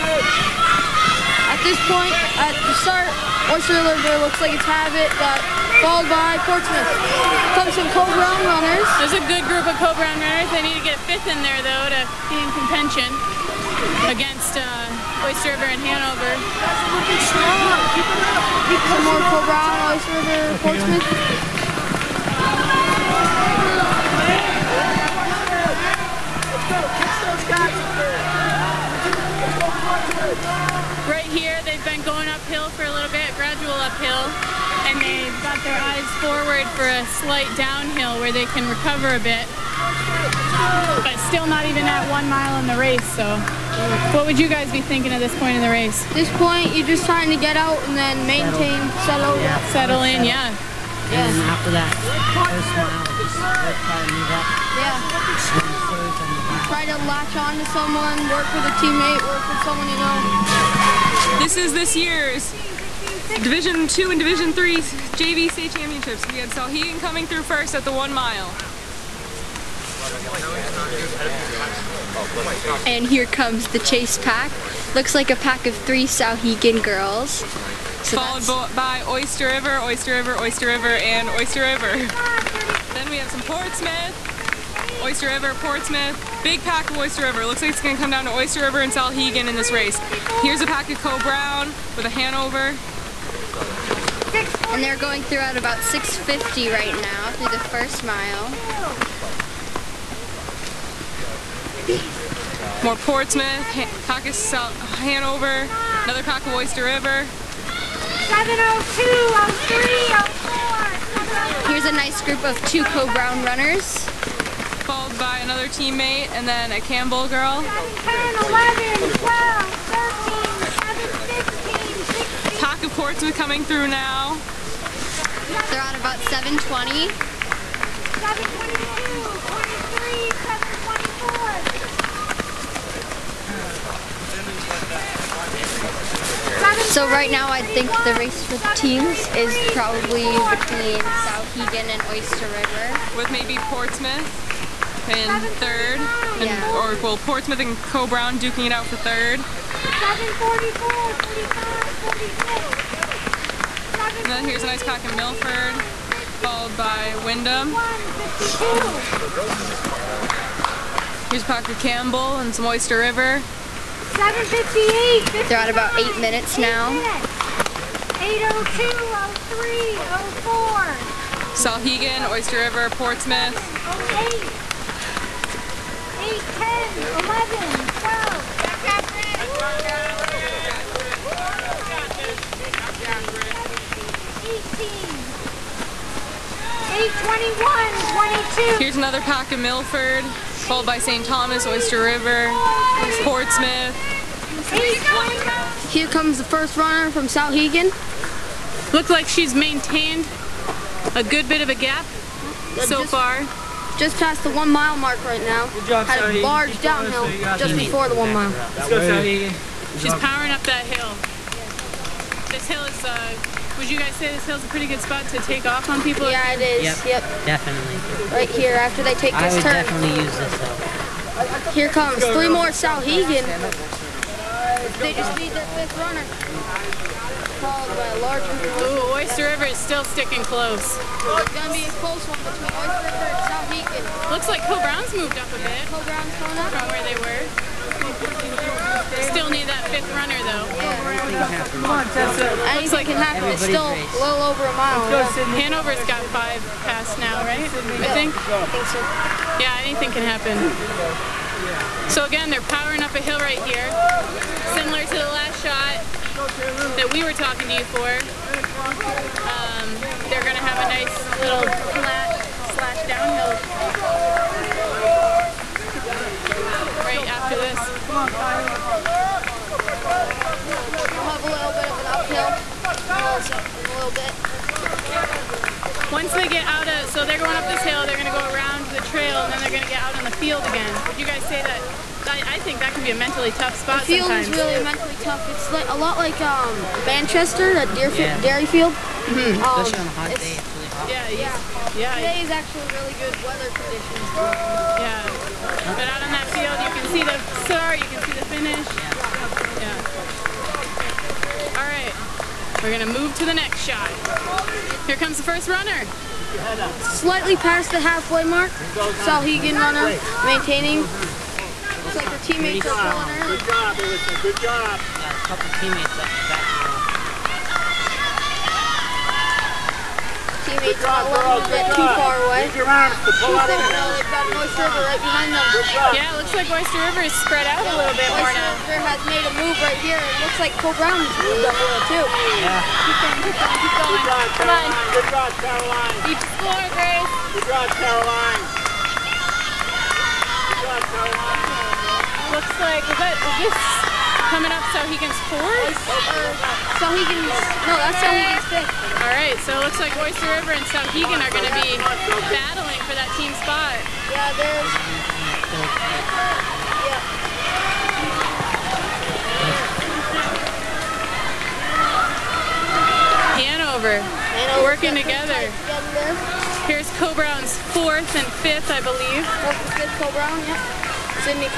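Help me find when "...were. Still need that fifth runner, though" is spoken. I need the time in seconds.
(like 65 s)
237 s.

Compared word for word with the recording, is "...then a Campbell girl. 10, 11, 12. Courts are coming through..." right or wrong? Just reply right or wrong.
right.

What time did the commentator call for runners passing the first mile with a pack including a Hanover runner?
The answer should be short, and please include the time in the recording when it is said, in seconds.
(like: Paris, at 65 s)
6:50, at 95 s.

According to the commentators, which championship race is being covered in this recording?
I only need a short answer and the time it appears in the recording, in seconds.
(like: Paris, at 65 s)
Division 2 and Division 3 JV state championships, at 63 s.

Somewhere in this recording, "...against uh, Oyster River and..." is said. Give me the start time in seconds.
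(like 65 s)
14 s.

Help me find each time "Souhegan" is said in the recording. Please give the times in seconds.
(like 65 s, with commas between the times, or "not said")
66 s, 76 s, 88 s, 141 s, 197 s, 222 s, 233 s, 350 s.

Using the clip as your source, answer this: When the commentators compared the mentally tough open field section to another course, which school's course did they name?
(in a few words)
Derryfield.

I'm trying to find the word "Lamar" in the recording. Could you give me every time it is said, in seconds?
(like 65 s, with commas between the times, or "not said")
not said.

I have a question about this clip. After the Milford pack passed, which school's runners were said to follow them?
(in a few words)
Windham.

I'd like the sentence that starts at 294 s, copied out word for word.
Yeah, but out on that field, you can see the start, you can see the finish.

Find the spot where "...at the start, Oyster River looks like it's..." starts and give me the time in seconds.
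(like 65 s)
2 s.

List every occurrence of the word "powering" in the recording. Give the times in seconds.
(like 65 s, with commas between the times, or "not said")
210 s, 252 s.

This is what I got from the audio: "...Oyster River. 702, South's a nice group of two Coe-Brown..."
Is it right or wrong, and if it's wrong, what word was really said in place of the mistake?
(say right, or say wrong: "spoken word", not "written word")
wrong: "Here", not "South".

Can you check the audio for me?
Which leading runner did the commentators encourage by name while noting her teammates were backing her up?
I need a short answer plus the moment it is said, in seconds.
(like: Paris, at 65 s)
Alyssa, at 313 s.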